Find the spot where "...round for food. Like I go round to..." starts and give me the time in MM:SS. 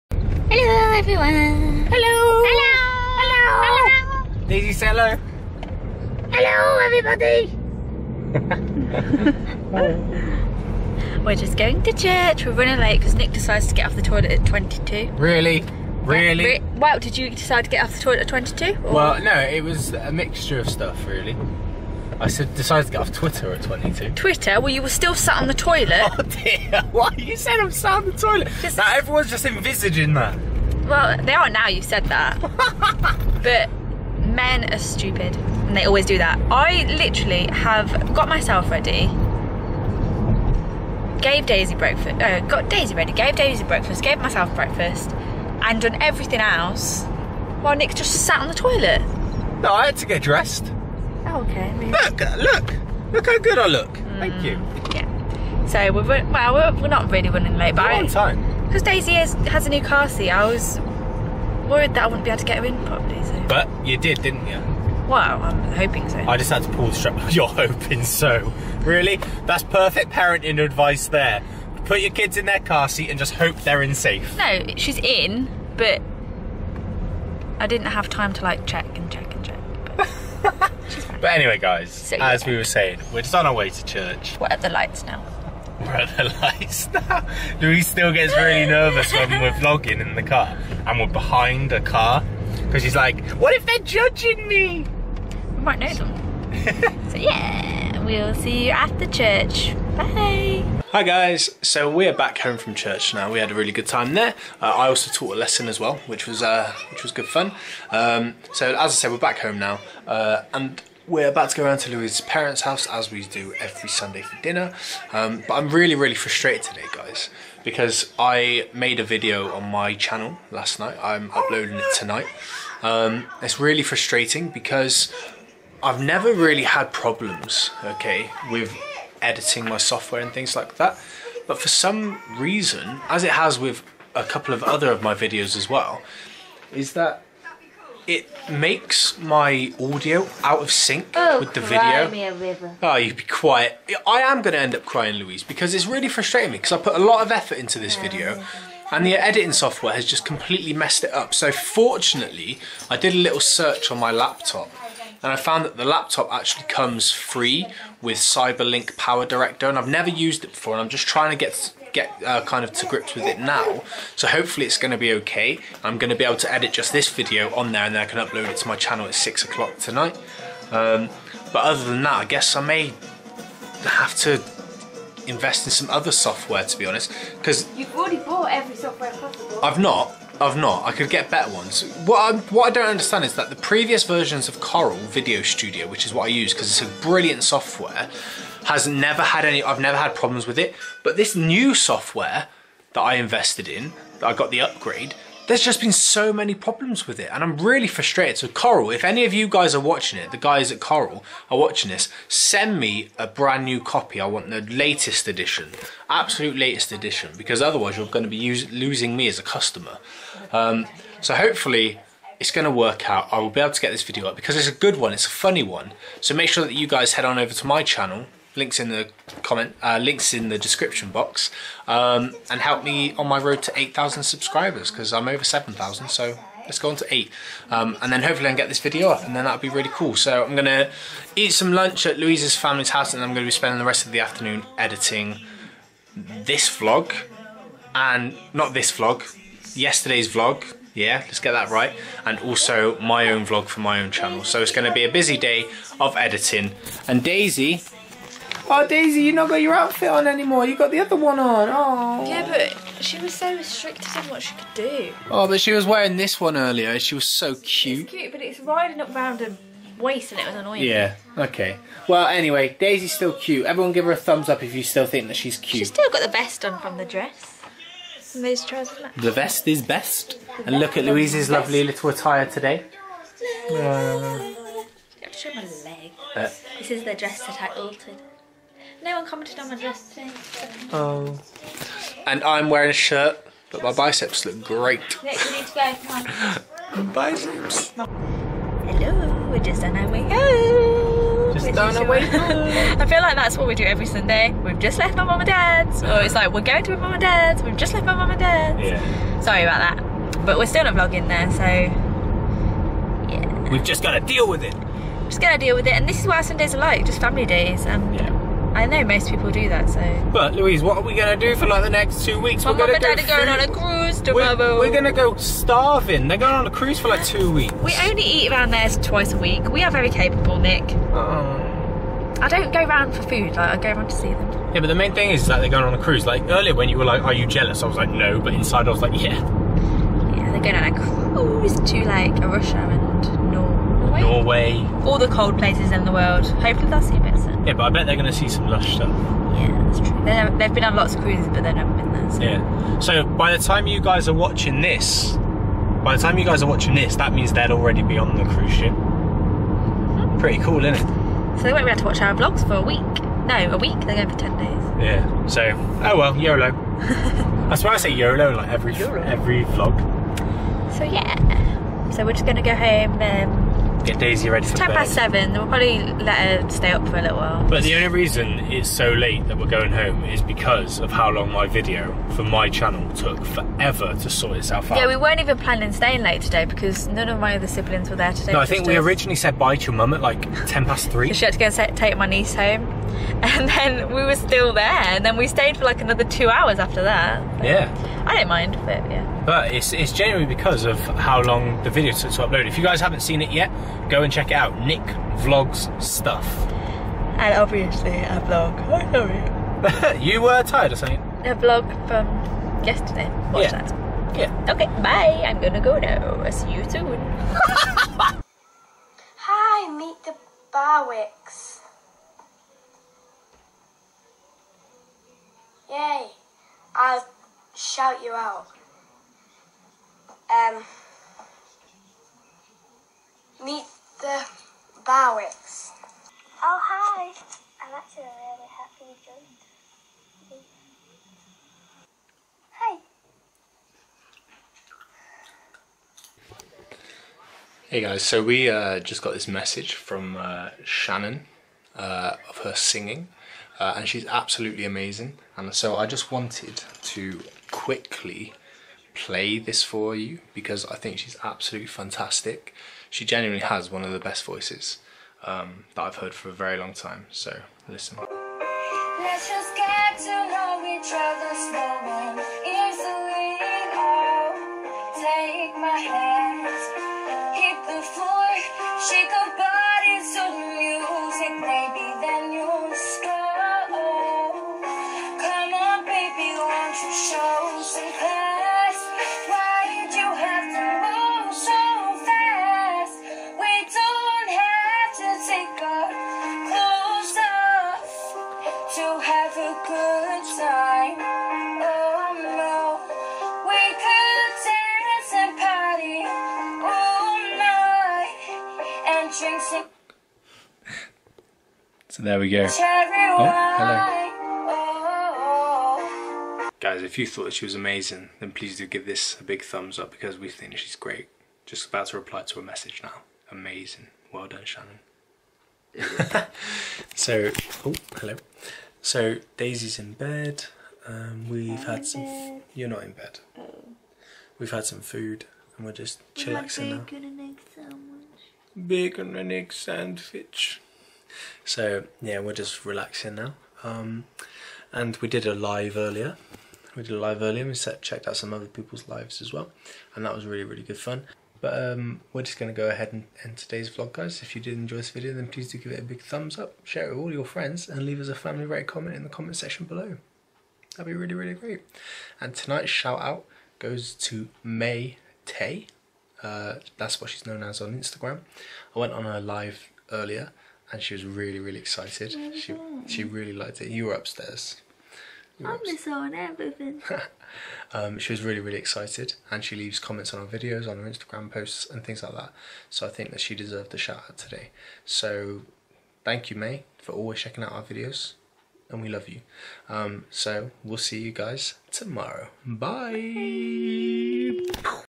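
05:22.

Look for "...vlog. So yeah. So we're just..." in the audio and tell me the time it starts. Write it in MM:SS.
05:59.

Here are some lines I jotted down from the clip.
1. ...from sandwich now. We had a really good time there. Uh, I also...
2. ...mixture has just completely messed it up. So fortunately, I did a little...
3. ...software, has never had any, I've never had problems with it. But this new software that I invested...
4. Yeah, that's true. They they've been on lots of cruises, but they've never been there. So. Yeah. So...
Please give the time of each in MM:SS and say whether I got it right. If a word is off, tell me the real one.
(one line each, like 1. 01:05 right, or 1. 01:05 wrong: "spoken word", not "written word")
1. 01:42 wrong: "church", not "sandwich"
2. 02:29 wrong: "software", not "mixture"
3. 03:07 right
4. 05:39 right.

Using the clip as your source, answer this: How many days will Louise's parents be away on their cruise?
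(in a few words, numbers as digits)
10.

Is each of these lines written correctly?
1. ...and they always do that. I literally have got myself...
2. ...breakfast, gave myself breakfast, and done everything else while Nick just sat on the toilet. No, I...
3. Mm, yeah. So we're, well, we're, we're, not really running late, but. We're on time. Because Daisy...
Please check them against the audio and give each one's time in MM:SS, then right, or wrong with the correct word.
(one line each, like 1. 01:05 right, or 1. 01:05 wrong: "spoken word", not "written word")
1. 00:35 right
2. 00:43 right
3. 00:54 right.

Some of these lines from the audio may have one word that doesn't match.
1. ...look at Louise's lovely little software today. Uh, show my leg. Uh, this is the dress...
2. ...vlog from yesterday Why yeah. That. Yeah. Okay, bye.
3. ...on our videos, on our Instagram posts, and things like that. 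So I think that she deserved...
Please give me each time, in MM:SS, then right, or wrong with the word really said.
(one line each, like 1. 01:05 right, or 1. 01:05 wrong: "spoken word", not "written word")
1. 04:30 wrong: "attire", not "software"
2. 06:41 wrong: "Watch", not "Why"
3. 09:30 right.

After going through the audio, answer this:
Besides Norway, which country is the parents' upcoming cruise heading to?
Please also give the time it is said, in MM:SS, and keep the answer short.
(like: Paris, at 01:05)
Russia, at 05:32.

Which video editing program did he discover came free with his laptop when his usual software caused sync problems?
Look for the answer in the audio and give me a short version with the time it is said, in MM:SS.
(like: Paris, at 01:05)
CyberLink Power Director, at 02:38.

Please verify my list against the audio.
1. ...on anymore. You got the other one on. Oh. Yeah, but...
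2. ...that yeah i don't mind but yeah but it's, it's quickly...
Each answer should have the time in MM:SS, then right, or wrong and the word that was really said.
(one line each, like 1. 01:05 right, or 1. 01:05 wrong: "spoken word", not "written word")
1. 04:10 right
2. 06:27 wrong: "generally", not "quickly".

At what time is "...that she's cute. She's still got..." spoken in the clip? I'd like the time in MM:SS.
04:25.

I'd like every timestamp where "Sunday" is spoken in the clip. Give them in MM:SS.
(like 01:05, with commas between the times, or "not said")
01:53, 04:54, 05:06.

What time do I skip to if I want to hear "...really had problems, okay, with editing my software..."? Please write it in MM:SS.
02:06.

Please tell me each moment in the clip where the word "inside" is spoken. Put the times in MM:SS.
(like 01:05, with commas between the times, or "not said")
05:28.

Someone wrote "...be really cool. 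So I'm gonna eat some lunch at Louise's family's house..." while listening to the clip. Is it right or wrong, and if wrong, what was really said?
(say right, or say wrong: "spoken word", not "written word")
right.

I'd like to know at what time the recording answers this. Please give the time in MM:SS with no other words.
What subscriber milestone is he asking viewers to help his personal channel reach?
03:43.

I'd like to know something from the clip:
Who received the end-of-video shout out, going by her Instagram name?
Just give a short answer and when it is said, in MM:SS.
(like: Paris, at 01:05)
Mai Tai, at 09:14.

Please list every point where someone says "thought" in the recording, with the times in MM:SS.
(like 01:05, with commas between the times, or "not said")
08:27.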